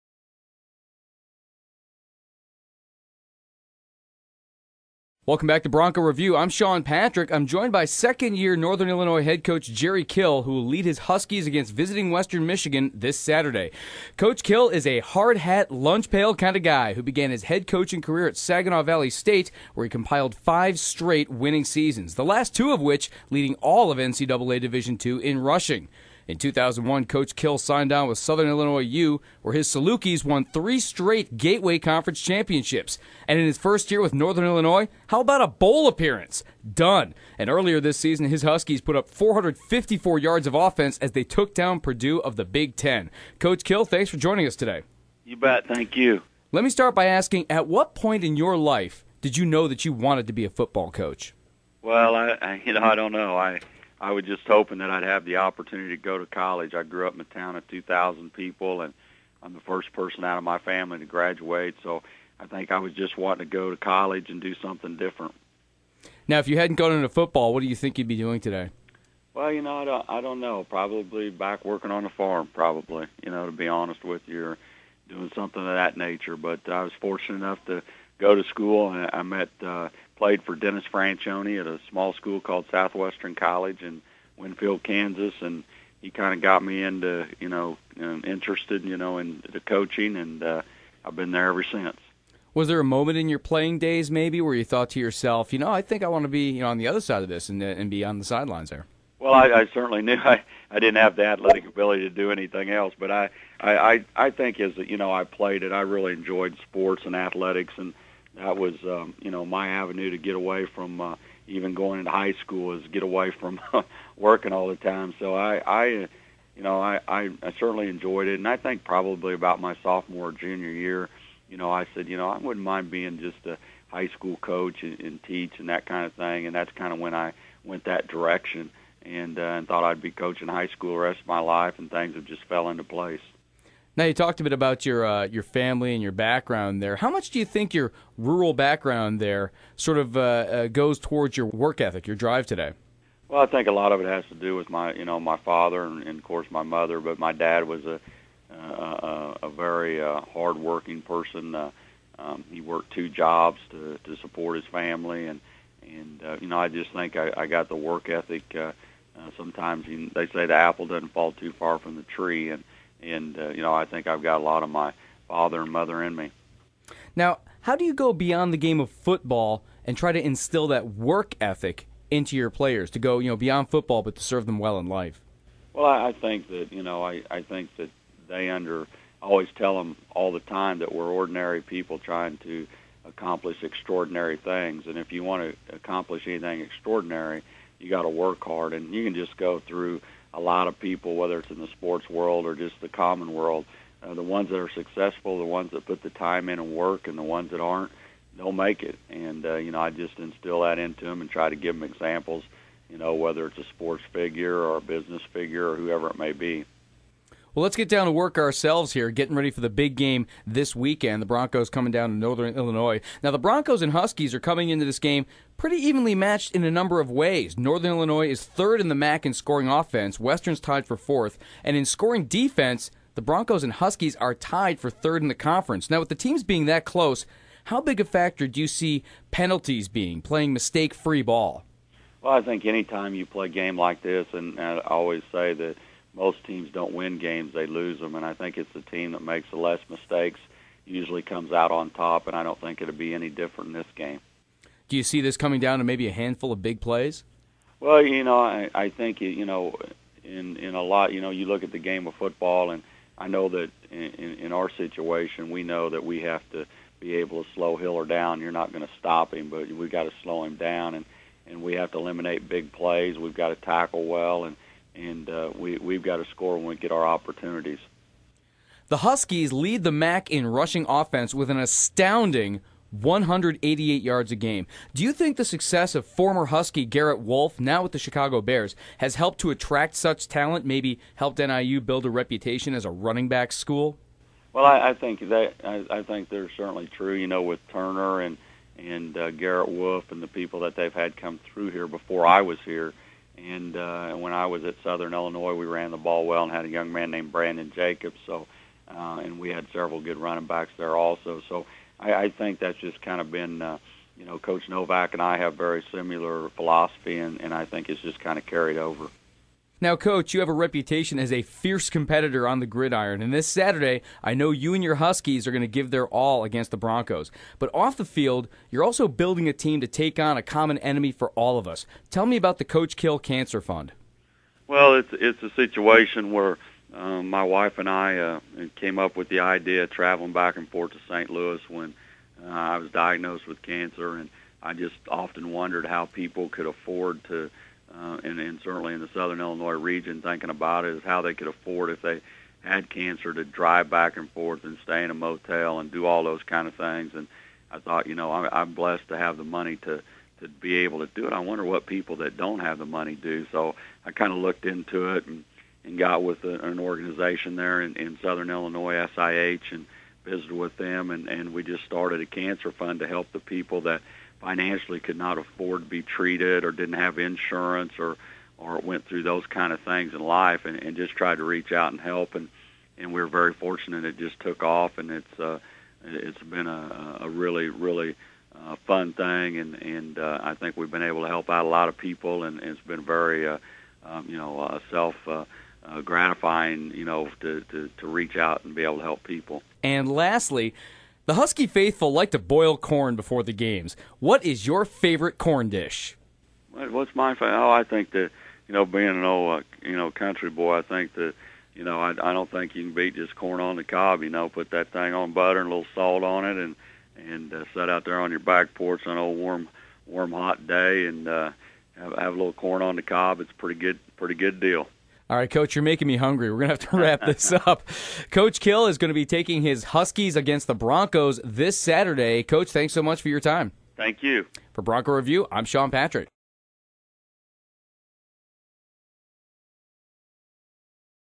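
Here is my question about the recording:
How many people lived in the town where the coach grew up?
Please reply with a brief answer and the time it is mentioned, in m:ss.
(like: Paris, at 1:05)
2,000, at 0:57.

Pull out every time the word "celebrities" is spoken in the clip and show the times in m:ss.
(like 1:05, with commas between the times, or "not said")
not said.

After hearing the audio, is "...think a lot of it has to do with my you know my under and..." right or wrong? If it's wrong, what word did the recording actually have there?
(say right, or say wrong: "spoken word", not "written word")
wrong: "father", not "under".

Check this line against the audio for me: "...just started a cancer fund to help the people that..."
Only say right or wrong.
right.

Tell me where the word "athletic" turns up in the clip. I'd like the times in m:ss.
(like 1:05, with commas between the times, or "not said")
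1:41, 1:47.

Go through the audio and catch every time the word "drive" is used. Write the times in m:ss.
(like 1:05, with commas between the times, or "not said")
2:22, 5:43.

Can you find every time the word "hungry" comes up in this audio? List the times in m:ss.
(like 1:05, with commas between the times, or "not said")
6:56.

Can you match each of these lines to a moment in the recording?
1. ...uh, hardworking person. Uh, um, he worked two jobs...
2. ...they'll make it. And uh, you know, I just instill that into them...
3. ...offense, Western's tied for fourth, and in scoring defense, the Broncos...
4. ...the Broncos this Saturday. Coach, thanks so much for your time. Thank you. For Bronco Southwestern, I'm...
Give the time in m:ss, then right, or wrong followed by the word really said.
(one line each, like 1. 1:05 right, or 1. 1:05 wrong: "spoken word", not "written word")
1. 2:30 right
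2. 3:18 right
3. 3:39 right
4. 7:00 wrong: "Review", not "Southwestern".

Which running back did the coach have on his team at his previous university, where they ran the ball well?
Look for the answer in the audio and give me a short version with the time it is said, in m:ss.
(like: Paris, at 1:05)
Brandon Jacobs, at 4:57.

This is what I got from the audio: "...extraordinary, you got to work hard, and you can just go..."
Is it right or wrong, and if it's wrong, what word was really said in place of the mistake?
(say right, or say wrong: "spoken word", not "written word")
right.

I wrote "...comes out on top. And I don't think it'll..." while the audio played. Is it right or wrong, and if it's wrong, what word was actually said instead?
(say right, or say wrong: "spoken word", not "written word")
right.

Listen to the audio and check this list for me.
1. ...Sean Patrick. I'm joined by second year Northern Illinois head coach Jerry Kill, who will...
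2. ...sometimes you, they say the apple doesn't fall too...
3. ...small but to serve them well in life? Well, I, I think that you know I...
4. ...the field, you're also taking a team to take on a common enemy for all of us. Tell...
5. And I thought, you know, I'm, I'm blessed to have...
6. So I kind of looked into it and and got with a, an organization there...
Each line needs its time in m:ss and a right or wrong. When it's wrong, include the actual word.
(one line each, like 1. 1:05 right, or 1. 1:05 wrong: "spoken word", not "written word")
1. 0:06 right
2. 2:39 right
3. 2:53 wrong: "football", not "small"
4. 5:17 wrong: "building", not "taking"
5. 5:47 right
6. 5:53 right.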